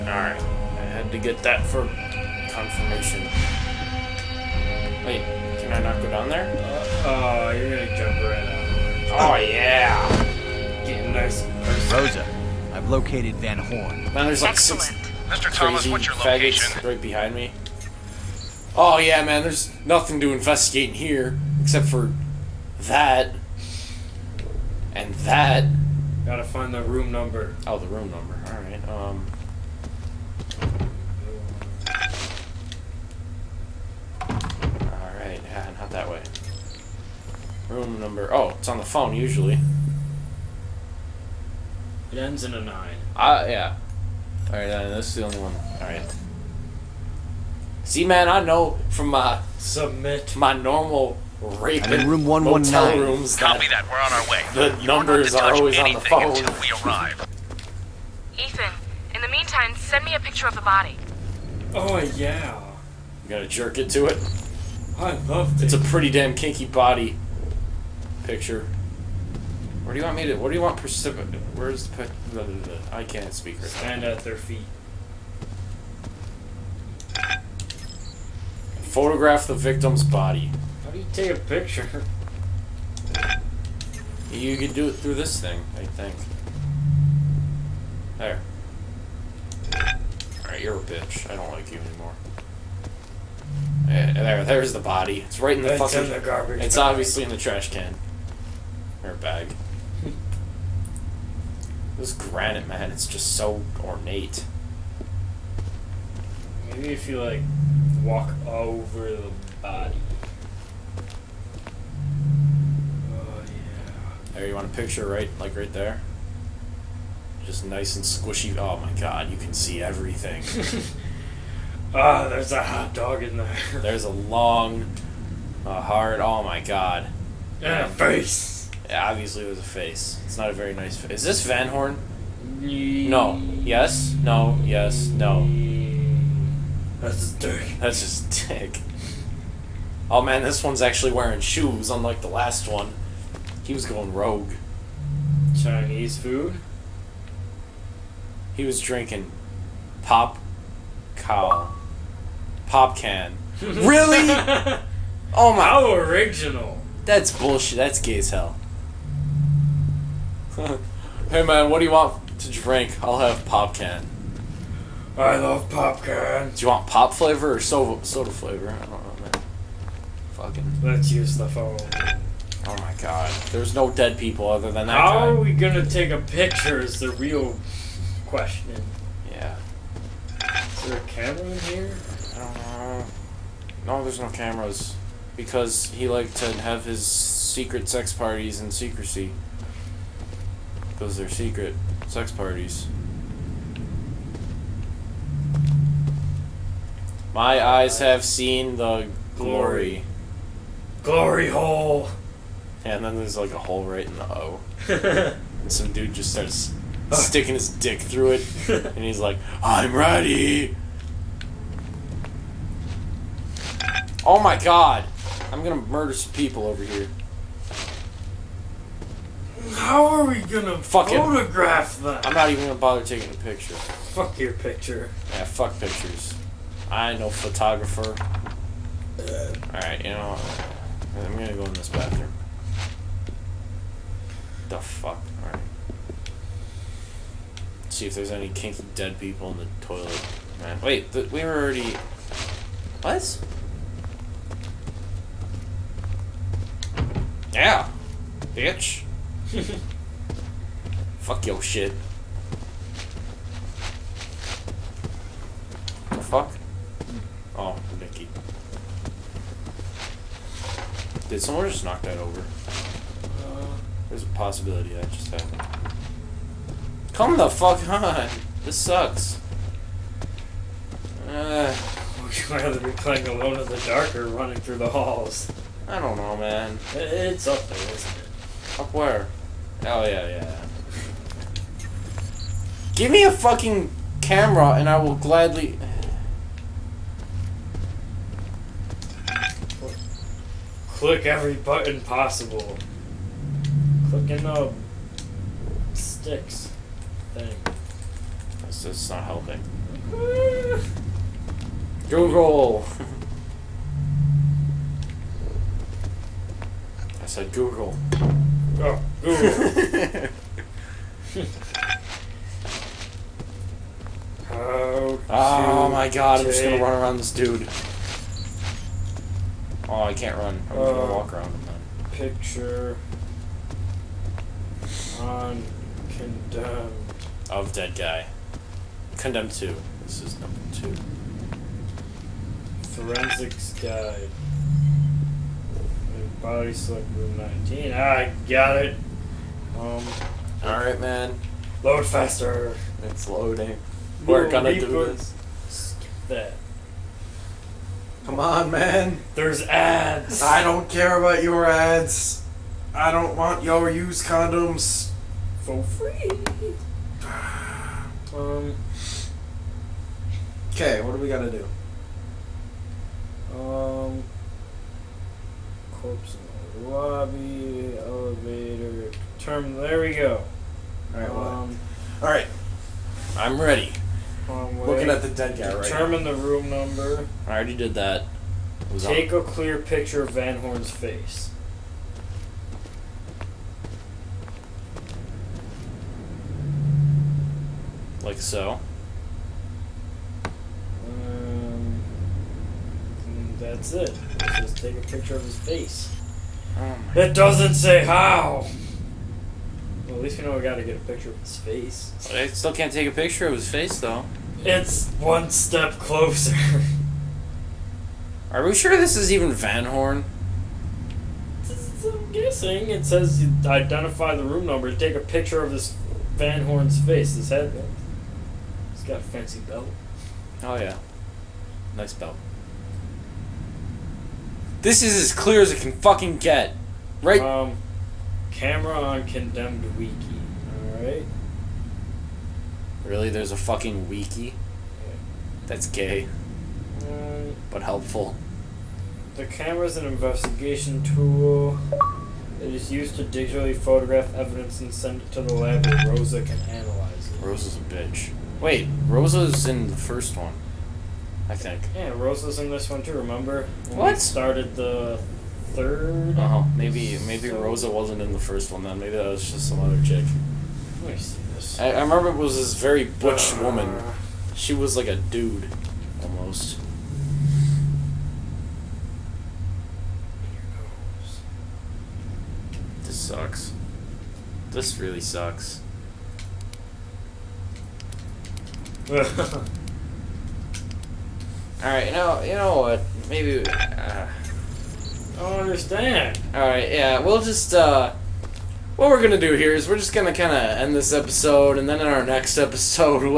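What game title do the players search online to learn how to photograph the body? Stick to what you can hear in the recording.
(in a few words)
Condemned 2.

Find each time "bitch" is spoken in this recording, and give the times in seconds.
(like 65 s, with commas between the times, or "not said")
90 s, 248 s, 447 s.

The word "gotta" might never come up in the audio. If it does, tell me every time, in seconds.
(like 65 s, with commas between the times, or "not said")
26 s, 63 s, 361 s.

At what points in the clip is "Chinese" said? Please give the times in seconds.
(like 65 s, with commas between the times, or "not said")
145 s.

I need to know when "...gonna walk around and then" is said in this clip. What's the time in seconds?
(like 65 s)
320 s.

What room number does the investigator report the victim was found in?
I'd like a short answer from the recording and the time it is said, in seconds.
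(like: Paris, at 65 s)
119, at 52 s.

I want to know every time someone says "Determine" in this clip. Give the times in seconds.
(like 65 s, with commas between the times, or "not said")
375 s.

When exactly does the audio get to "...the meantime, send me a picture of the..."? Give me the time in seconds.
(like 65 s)
59 s.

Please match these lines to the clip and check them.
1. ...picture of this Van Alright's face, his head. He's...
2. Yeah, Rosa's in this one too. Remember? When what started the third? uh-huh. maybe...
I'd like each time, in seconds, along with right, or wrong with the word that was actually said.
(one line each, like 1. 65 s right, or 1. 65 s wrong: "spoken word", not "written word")
1. 415 s wrong: "Horn", not "Alright"
2. 451 s right.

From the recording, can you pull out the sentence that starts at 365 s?
Corpse in the lobby, elevator, terminal.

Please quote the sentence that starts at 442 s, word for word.
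It is used to digitally photograph evidence and send it to the lab where Rosa can analyze it.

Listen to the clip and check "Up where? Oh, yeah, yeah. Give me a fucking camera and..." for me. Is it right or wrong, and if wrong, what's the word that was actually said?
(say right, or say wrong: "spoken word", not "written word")
right.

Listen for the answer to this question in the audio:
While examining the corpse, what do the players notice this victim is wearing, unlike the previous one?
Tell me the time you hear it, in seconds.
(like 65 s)
141 s.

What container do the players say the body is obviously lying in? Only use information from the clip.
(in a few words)
The trash can.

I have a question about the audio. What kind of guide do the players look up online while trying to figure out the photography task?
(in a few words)
Forensics guide.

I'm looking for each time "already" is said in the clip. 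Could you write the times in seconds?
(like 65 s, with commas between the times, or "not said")
241 s, 377 s.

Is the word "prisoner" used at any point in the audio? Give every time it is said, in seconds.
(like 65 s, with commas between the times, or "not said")
not said.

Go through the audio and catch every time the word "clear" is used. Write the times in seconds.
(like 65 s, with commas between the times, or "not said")
379 s, 425 s.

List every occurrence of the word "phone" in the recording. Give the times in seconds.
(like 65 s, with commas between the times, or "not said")
38 s, 56 s, 171 s.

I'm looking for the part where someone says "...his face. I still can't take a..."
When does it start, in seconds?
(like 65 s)
401 s.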